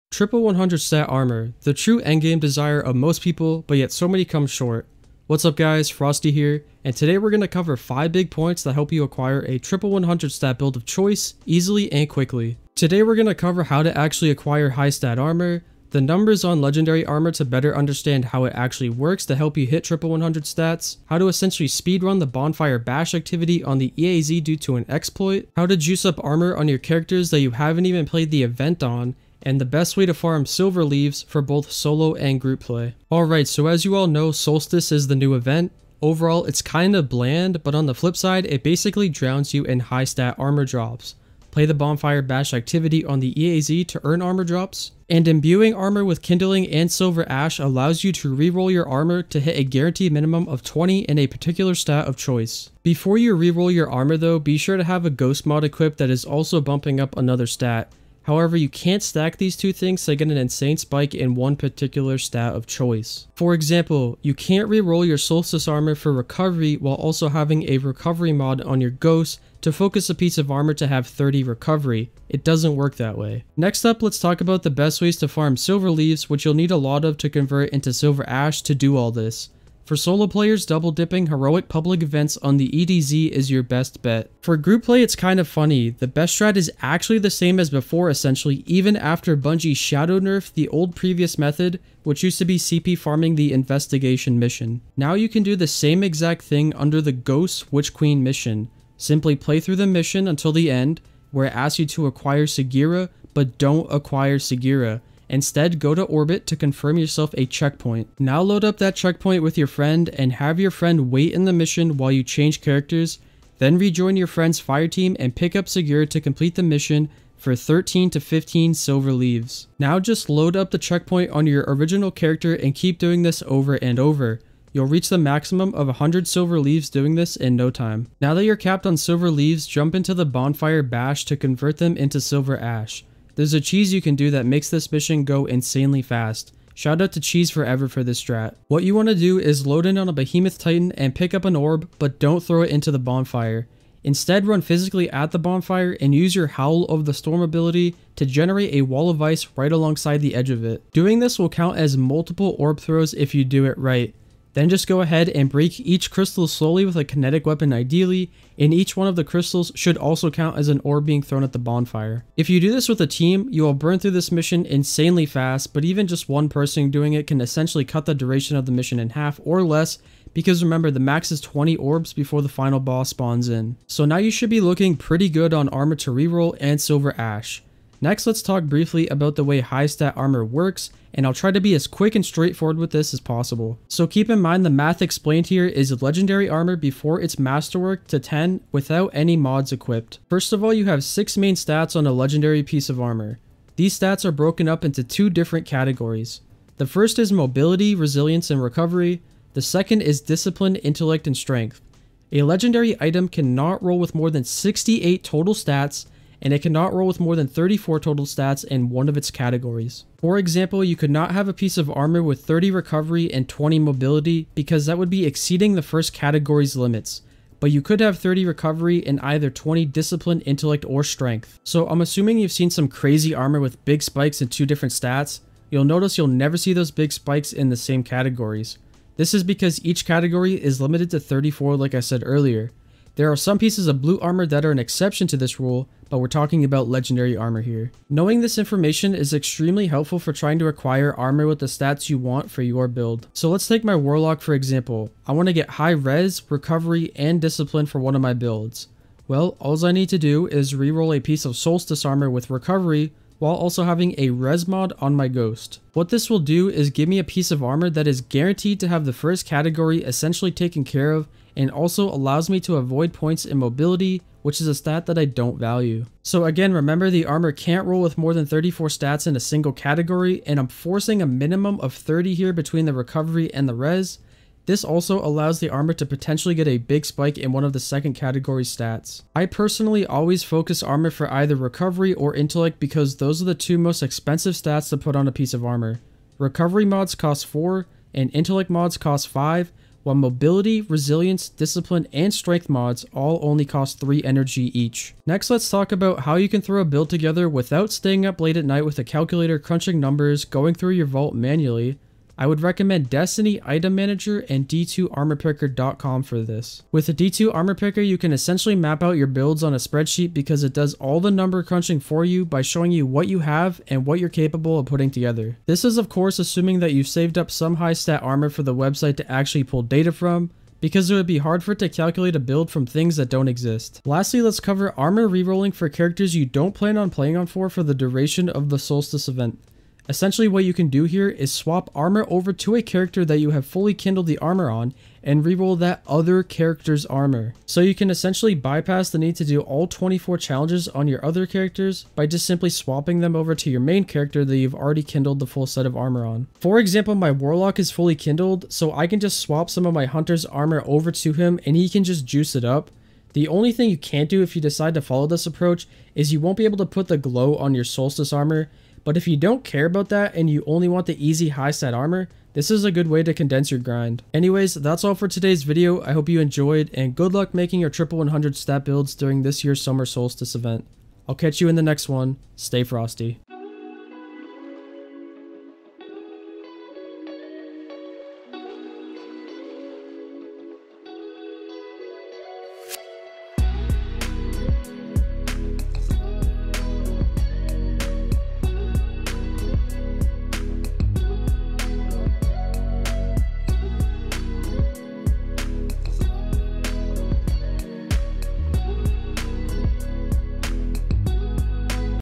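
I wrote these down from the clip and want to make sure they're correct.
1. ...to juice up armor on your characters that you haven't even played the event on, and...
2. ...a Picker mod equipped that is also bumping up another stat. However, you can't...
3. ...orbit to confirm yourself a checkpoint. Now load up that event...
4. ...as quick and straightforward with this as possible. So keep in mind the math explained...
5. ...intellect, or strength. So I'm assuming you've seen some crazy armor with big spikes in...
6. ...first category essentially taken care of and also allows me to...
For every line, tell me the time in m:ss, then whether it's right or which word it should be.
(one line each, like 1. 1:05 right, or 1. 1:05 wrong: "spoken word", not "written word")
1. 0:25 right
2. 0:55 wrong: "Ghost", not "Picker"
3. 1:46 wrong: "checkpoint", not "event"
4. 3:01 right
5. 3:40 right
6. 4:19 right.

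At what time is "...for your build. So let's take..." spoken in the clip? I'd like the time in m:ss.
4:02.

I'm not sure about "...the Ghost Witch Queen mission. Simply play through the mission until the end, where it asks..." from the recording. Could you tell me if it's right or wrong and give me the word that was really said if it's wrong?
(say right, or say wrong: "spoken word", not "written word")
right.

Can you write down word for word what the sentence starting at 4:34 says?
This also allows the armor to potentially get a big spike in one of the second category stats.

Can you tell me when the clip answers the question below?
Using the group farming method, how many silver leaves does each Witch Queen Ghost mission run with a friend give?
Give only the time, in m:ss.
1:57.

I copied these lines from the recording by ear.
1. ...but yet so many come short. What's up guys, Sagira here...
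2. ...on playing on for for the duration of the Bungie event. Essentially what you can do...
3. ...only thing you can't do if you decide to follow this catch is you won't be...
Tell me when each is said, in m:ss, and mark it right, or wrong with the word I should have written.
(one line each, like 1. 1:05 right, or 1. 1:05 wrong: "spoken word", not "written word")
1. 0:03 wrong: "Frosty", not "Sagira"
2. 5:26 wrong: "Solstice", not "Bungie"
3. 5:53 wrong: "approach", not "catch".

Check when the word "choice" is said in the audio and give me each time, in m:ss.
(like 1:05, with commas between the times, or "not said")
0:10, 0:52, 1:02.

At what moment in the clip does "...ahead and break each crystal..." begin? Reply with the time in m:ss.
2:35.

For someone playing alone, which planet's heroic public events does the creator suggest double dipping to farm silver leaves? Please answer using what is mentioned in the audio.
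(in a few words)
EDZ.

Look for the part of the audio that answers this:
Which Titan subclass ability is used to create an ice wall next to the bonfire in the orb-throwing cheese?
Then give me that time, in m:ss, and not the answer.
2:26.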